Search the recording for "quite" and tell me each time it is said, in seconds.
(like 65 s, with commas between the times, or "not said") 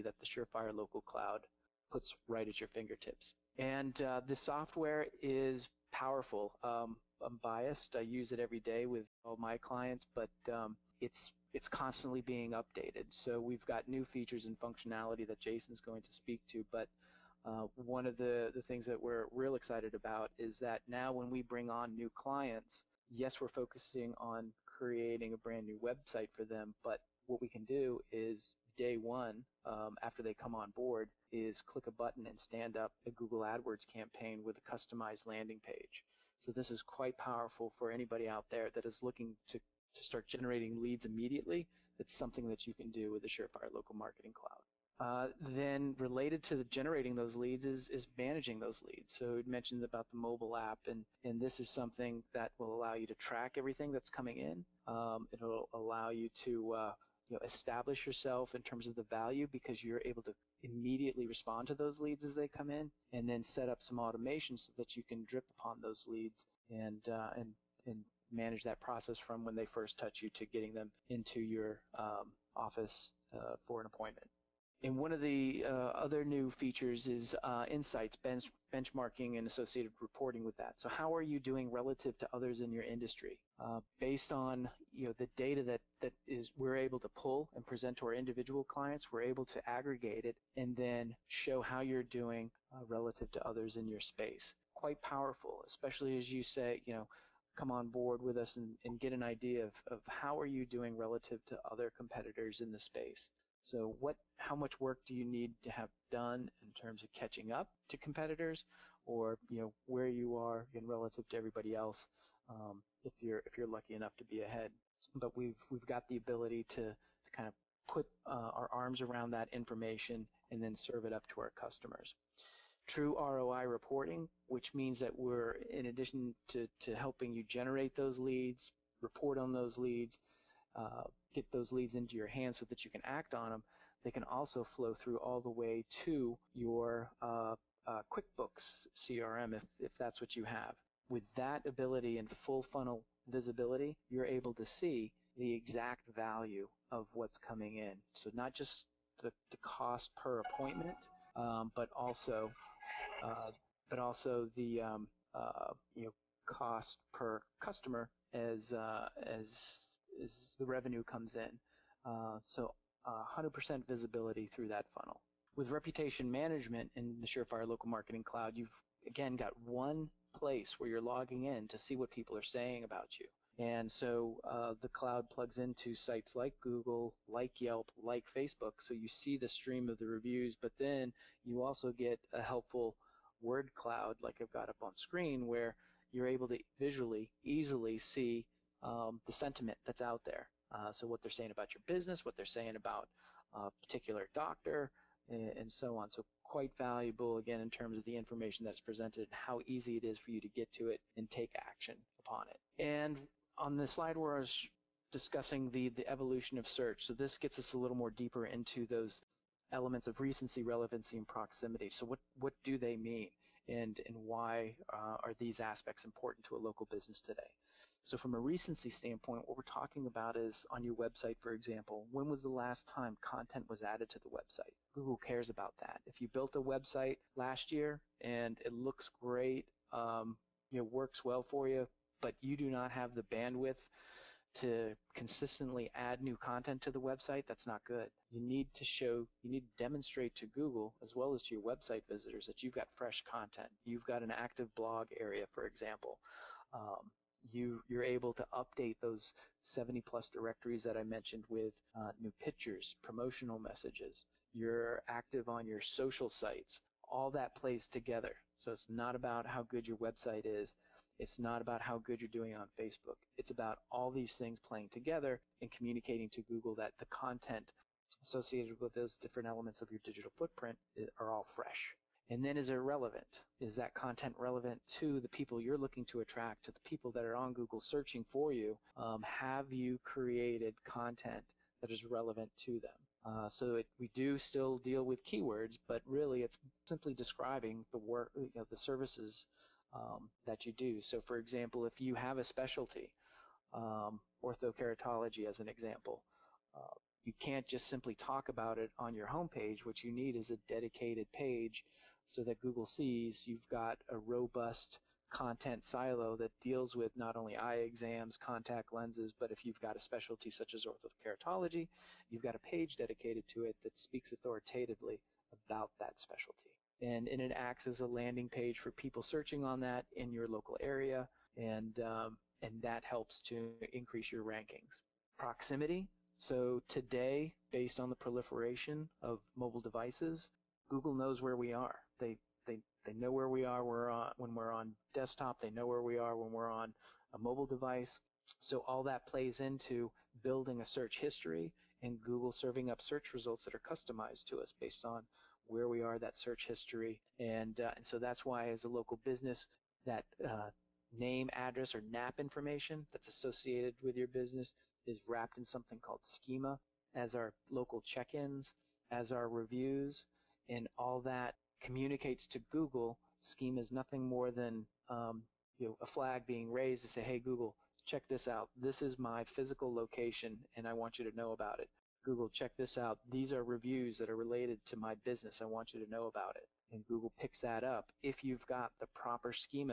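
36 s, 94 s, 196 s.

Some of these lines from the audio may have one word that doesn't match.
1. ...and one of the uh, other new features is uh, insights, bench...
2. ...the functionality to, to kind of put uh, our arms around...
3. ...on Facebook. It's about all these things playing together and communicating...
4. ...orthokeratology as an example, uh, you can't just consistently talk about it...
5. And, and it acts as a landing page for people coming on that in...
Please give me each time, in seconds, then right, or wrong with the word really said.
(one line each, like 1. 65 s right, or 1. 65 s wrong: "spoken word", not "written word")
1. 74 s right
2. 116 s wrong: "ability", not "functionality"
3. 262 s right
4. 294 s wrong: "simply", not "consistently"
5. 316 s wrong: "searching", not "coming".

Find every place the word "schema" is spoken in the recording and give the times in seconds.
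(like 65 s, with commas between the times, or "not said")
356 s, 363 s.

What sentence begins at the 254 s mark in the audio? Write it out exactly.
You're active on your social sites.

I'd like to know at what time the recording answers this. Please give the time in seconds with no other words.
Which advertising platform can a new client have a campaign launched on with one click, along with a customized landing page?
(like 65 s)
33 s.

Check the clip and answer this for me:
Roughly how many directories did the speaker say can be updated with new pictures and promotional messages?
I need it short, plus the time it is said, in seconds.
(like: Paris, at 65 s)
70 plus, at 249 s.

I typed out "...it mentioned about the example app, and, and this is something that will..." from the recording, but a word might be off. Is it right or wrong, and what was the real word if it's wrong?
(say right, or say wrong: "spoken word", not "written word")
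wrong: "mobile", not "example".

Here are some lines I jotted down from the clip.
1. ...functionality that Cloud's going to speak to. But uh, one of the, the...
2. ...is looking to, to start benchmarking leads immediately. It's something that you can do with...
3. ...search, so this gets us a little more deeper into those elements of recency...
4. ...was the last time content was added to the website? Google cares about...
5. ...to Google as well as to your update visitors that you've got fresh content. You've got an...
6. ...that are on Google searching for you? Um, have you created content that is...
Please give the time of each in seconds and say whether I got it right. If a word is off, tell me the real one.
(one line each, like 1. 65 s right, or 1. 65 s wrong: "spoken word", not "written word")
1. 14 s wrong: "Jason", not "Cloud"
2. 38 s wrong: "generating", not "benchmarking"
3. 206 s right
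4. 222 s right
5. 240 s wrong: "website", not "update"
6. 277 s right.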